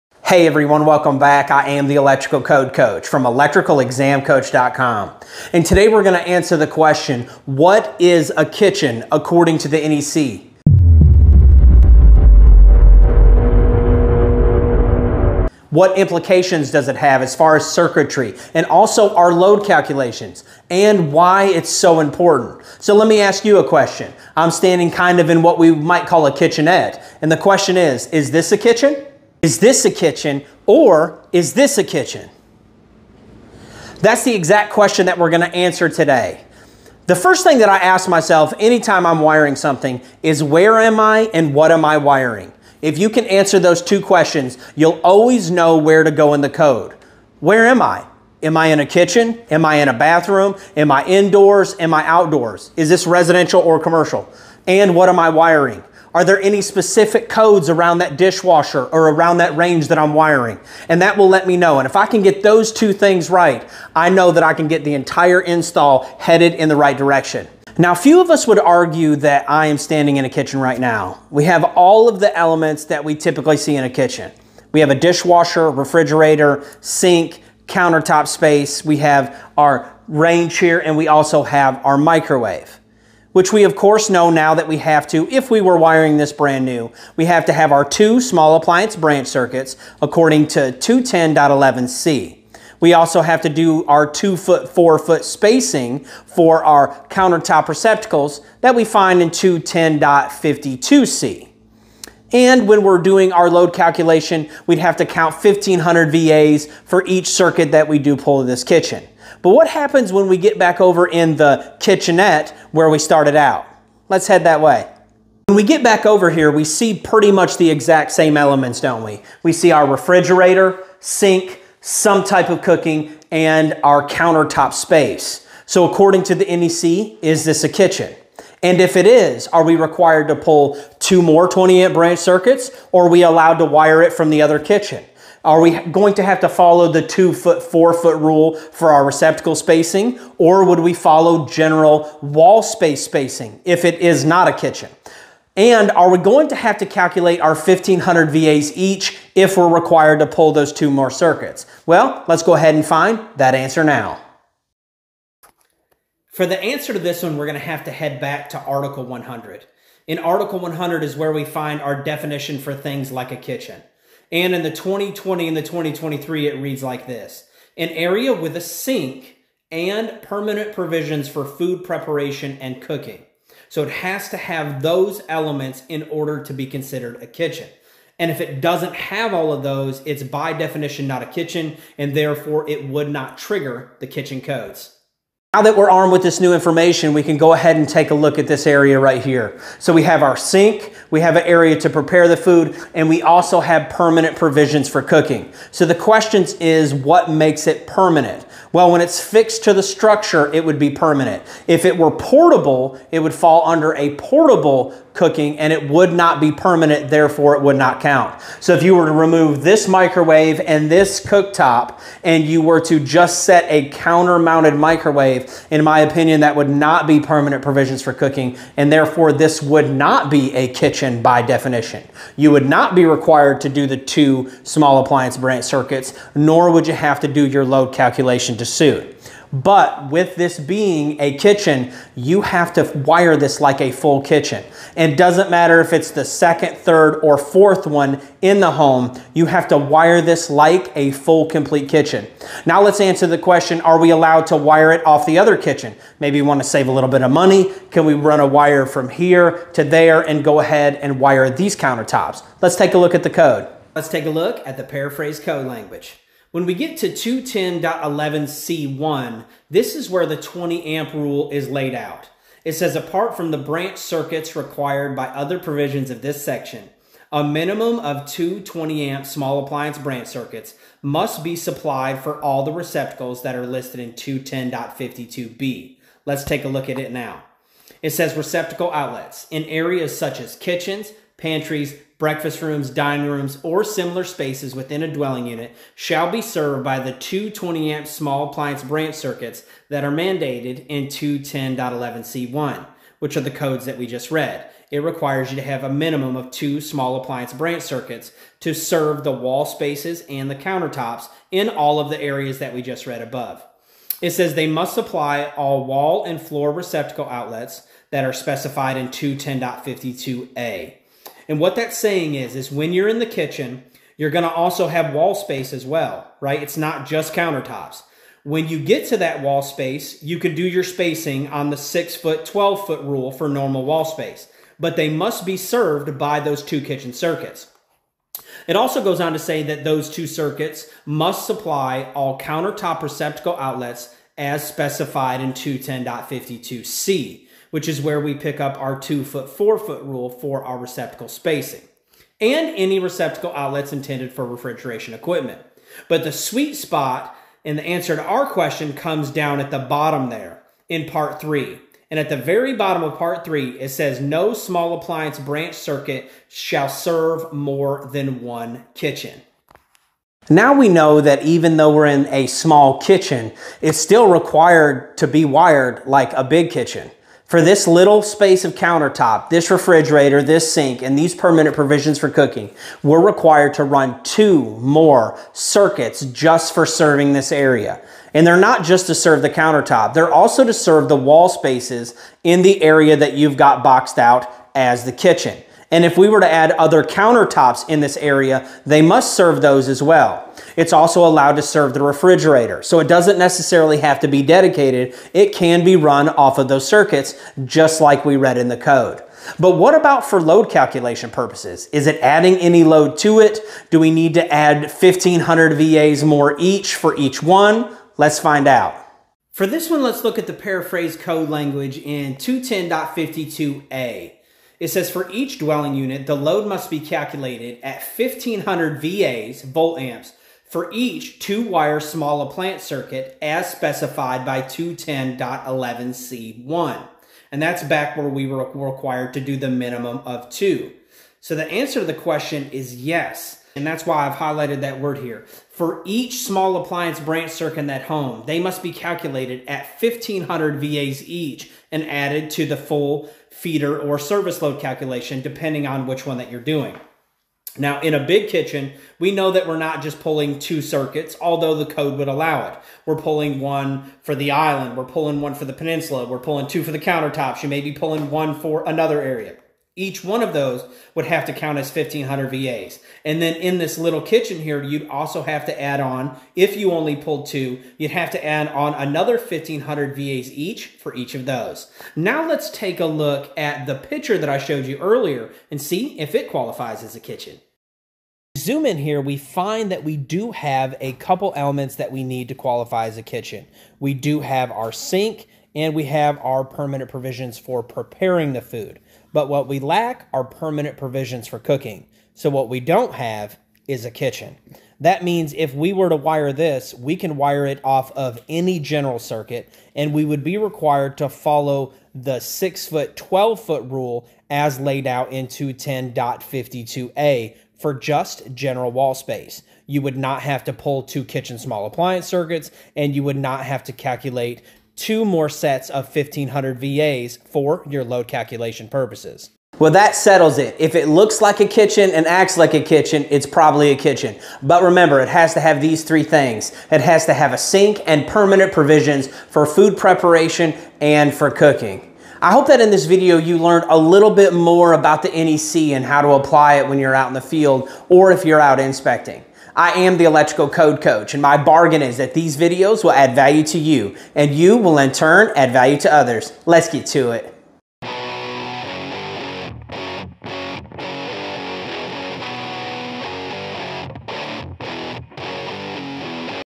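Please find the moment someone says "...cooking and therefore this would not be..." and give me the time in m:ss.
3:38.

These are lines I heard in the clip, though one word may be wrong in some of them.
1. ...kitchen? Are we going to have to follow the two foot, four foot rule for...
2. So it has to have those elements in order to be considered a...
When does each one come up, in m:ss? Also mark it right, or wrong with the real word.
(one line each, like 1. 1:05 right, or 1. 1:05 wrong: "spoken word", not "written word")
1. 2:14 right
2. 2:53 right.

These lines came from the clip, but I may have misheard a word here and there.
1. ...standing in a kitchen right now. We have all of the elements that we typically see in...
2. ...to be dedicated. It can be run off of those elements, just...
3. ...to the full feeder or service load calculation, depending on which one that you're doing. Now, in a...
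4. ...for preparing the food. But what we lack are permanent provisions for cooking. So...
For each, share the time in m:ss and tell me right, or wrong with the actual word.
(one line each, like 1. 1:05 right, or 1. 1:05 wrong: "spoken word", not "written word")
1. 1:09 right
2. 6:34 wrong: "circuits", not "elements"
3. 7:22 right
4. 8:07 right.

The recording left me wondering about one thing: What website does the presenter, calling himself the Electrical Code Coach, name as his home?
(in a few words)
electricalexamcoach.com.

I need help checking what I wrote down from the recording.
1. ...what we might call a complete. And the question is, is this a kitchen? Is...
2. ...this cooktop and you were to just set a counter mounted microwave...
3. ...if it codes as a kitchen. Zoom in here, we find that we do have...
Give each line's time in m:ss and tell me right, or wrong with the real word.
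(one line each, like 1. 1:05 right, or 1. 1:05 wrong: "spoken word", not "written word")
1. 0:25 wrong: "kitchenette", not "complete"
2. 3:30 right
3. 7:56 wrong: "qualifies", not "codes".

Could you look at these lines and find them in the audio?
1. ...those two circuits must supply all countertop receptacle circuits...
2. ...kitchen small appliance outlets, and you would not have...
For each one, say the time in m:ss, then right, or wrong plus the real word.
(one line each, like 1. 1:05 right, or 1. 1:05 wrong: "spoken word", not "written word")
1. 5:29 wrong: "outlets", not "circuits"
2. 8:31 wrong: "circuits", not "outlets".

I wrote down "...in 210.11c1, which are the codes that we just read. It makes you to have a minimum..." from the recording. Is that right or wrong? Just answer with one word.
wrong.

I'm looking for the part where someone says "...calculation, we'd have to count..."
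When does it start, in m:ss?
1:43.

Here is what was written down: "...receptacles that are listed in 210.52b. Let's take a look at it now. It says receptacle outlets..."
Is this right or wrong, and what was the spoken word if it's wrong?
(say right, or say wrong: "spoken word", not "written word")
right.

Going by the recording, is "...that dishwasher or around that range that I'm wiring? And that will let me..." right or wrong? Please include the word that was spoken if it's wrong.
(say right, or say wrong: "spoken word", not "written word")
right.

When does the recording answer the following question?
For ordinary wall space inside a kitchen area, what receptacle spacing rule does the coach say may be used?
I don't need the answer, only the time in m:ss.
5:21.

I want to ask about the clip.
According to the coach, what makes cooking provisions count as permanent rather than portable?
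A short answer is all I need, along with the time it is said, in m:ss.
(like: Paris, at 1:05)
Fixed to the structure, at 3:19.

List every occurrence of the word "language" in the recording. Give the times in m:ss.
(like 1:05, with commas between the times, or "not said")
4:15, 6:51.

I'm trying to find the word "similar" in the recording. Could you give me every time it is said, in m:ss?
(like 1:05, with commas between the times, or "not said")
4:43.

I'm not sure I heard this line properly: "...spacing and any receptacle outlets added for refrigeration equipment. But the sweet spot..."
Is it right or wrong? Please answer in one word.
wrong.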